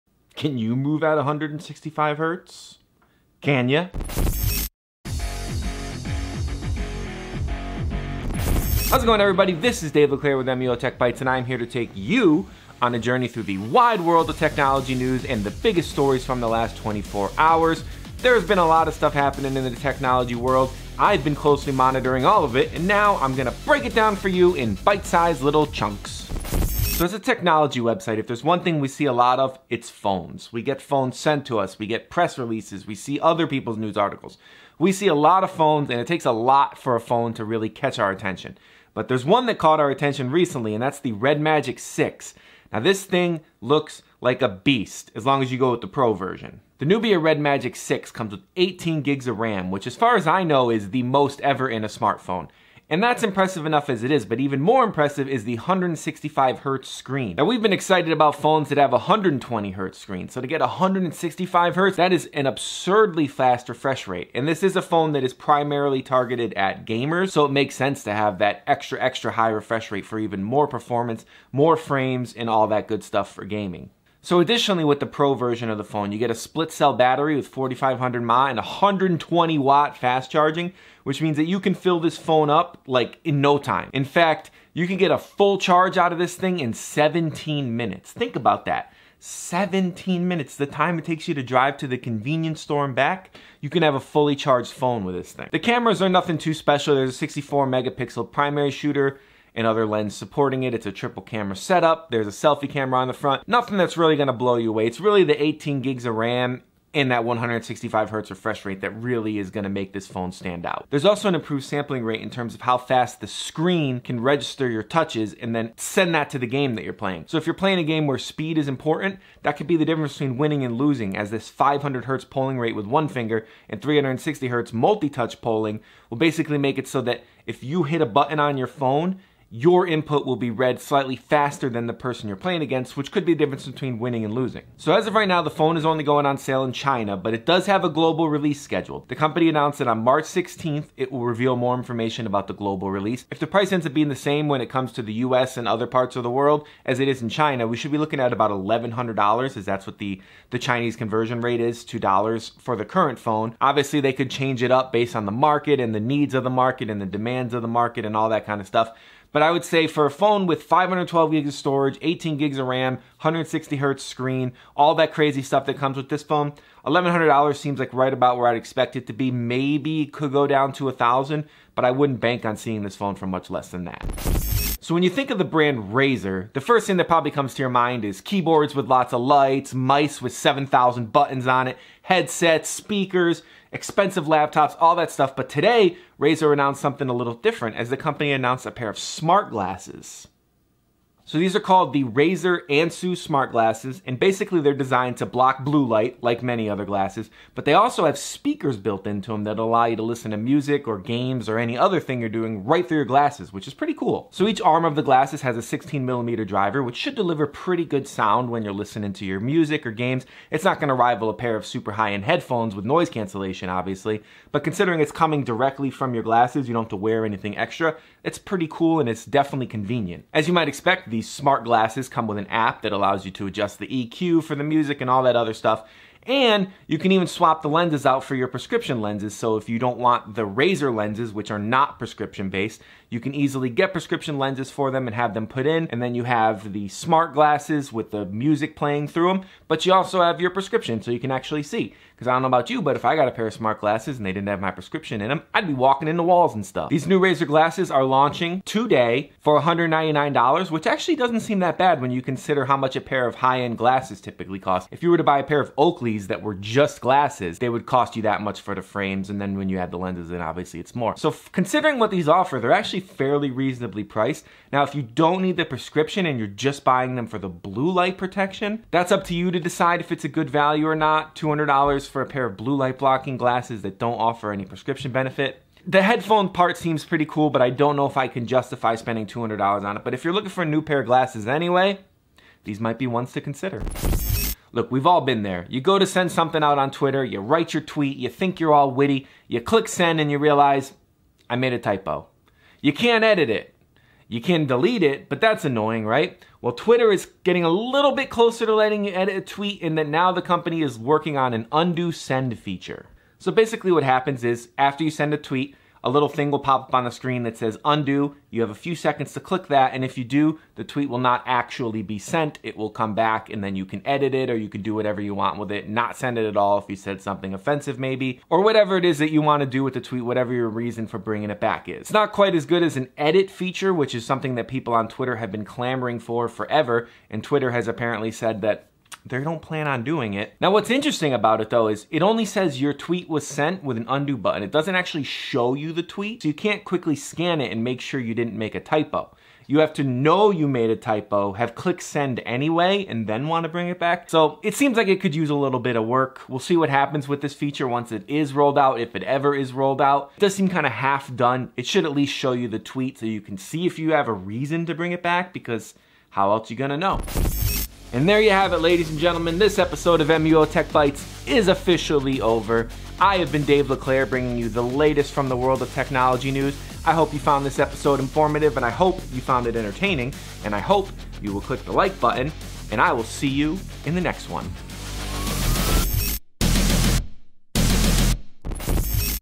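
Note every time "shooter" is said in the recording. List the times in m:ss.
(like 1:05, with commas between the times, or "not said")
1:38.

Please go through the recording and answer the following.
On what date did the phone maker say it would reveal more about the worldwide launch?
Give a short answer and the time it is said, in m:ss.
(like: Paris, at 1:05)
March 16th, at 2:20.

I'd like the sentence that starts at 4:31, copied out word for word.
$200 for a pair of blue light blocking glasses that don't offer any prescription benefit.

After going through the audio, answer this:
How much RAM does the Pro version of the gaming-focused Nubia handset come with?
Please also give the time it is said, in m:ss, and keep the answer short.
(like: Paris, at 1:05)
18 gigs, at 0:48.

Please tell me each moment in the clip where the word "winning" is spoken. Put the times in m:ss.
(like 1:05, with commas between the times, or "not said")
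2:00, 2:13.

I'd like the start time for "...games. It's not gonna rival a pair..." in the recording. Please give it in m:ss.
3:29.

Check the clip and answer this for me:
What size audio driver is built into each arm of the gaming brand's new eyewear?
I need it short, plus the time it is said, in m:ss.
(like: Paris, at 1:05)
16 millimeter, at 3:25.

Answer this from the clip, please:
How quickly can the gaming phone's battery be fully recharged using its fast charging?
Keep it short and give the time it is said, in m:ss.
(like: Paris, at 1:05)
17 minutes, at 1:26.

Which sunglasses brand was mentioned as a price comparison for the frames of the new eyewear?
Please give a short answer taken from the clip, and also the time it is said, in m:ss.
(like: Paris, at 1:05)
Oakley, at 4:15.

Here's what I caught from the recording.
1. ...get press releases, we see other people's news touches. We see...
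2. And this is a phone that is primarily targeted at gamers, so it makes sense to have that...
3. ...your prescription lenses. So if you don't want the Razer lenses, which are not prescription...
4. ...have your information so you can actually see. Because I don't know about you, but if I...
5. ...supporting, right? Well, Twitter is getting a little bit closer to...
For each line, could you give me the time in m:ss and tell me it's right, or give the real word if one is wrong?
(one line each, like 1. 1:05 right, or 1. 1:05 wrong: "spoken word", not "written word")
1. 0:31 wrong: "articles", not "touches"
2. 1:04 right
3. 3:48 right
4. 4:00 wrong: "prescription", not "information"
5. 4:55 wrong: "annoying", not "supporting".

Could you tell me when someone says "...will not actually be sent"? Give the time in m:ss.
5:11.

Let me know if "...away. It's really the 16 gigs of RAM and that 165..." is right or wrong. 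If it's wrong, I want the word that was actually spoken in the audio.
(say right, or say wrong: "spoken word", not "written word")
wrong: "18", not "16".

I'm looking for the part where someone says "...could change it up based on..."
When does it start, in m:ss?
2:34.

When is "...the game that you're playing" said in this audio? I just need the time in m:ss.
1:56.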